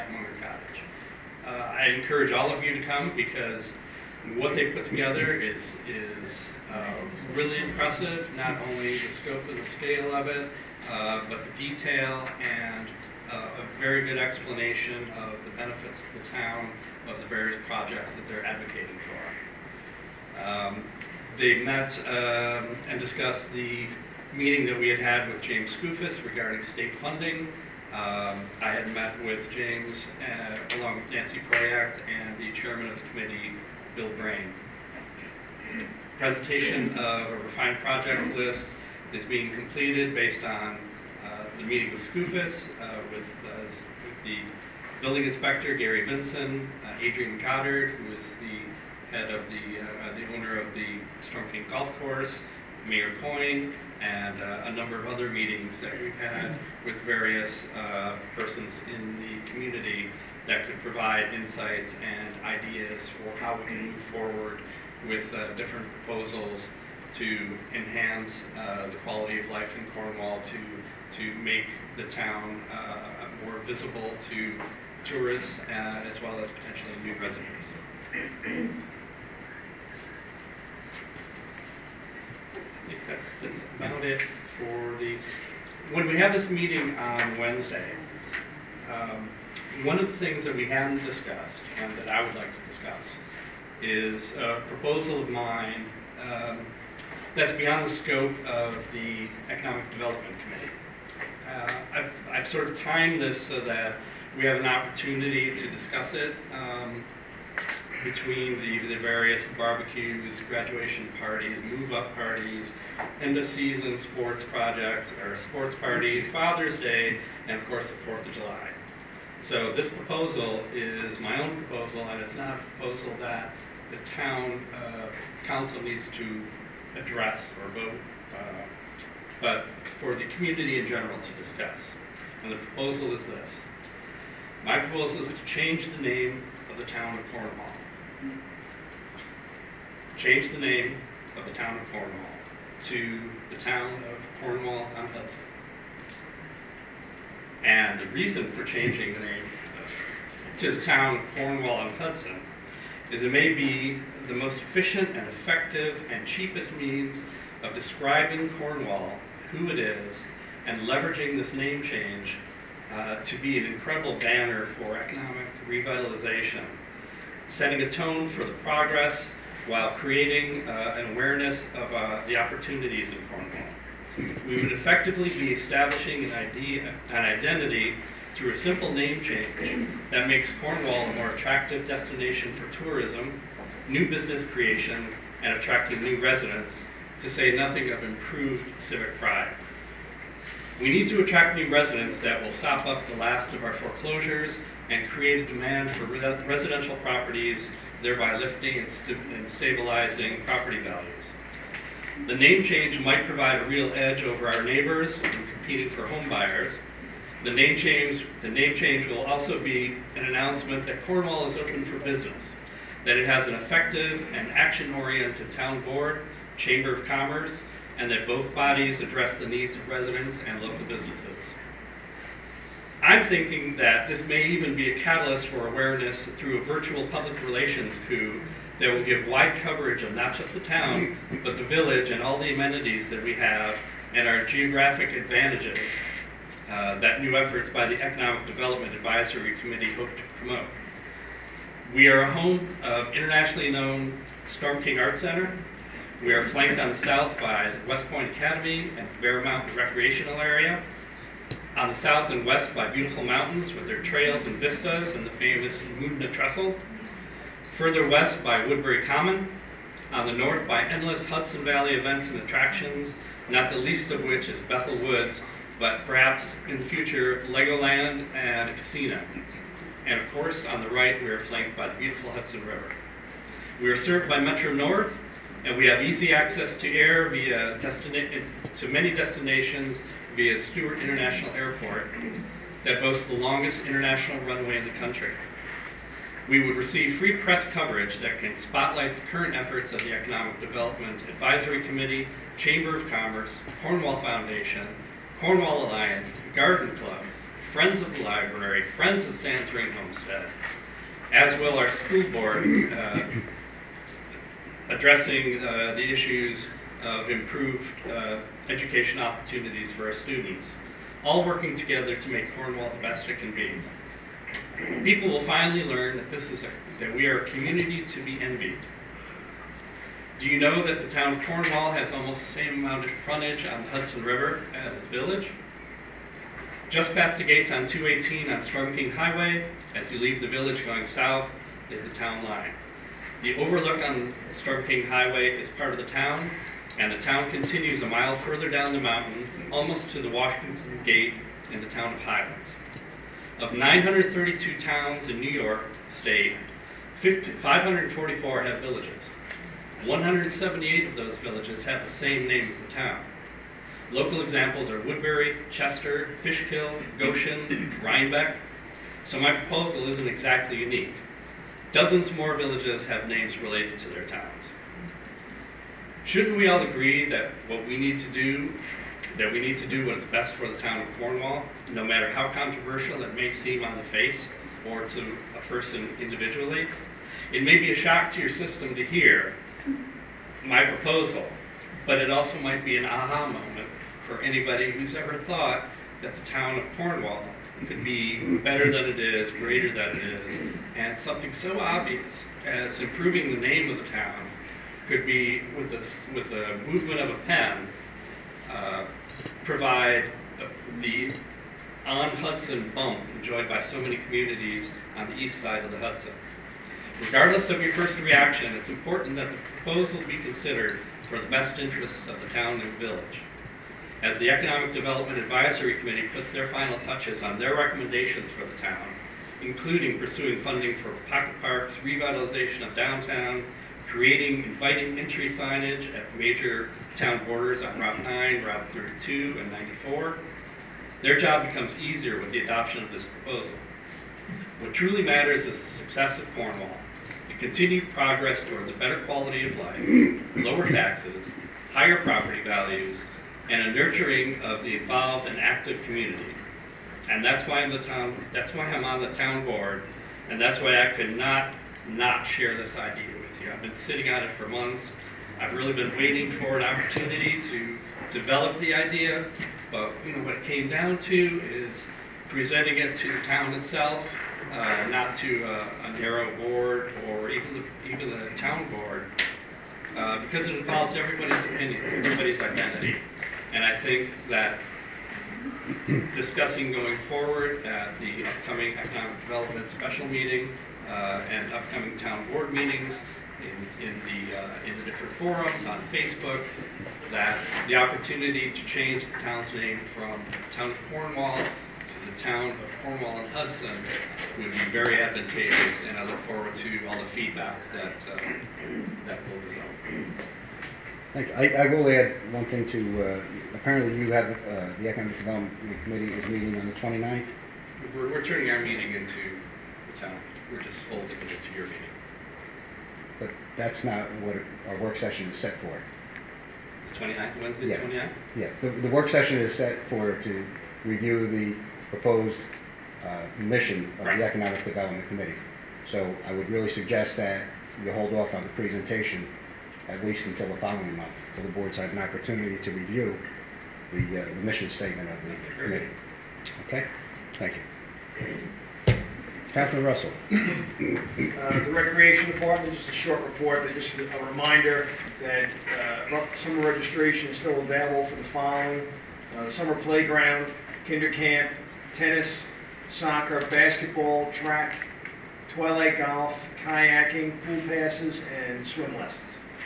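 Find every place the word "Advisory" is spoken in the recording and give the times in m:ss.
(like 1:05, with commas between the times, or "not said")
3:58, 4:51, 6:55.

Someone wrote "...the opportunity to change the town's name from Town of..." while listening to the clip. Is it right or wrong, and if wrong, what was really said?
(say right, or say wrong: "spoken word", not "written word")
right.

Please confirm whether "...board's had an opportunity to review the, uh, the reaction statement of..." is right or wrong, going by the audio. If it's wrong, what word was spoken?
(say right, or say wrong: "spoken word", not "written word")
wrong: "mission", not "reaction".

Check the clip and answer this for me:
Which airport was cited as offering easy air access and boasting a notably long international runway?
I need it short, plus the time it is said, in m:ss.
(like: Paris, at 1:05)
Stewart International Airport, at 4:40.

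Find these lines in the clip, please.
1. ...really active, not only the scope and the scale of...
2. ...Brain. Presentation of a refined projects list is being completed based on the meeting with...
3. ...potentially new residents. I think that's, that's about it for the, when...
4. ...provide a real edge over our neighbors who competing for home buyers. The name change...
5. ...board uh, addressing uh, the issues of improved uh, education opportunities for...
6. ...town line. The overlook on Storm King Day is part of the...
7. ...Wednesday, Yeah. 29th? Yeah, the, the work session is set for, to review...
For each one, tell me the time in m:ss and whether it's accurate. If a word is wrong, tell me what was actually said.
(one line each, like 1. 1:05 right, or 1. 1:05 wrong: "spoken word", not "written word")
1. 0:07 wrong: "impressive", not "active"
2. 0:34 right
3. 1:16 right
4. 3:23 right
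5. 5:02 right
6. 5:32 wrong: "Highway", not "Day"
7. 8:37 right.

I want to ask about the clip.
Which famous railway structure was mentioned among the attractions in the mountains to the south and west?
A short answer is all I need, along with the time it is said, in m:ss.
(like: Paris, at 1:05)
Moodna Trestle, at 4:15.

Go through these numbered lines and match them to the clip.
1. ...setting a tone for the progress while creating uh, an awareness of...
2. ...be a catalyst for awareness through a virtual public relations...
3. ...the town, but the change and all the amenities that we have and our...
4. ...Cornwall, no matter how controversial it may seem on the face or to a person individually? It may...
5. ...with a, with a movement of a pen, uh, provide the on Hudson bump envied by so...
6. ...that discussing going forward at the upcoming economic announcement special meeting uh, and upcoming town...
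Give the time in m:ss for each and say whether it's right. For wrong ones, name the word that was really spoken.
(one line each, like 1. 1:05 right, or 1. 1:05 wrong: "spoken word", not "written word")
1. 2:47 right
2. 3:44 right
3. 3:50 wrong: "village", not "change"
4. 6:11 right
5. 6:35 wrong: "enjoyed", not "envied"
6. 7:54 wrong: "development", not "announcement".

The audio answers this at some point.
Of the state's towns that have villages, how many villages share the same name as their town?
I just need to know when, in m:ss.
5:50.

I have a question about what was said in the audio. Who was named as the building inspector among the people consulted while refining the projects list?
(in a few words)
Gary Benson.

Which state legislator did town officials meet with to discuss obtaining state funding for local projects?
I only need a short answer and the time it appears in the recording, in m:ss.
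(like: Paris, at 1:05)
James Skoufis, at 0:25.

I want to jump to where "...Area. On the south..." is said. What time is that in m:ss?
4:10.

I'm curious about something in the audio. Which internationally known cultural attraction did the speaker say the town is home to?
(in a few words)
Storm King Art Center.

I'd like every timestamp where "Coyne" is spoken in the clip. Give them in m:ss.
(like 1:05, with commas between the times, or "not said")
0:53.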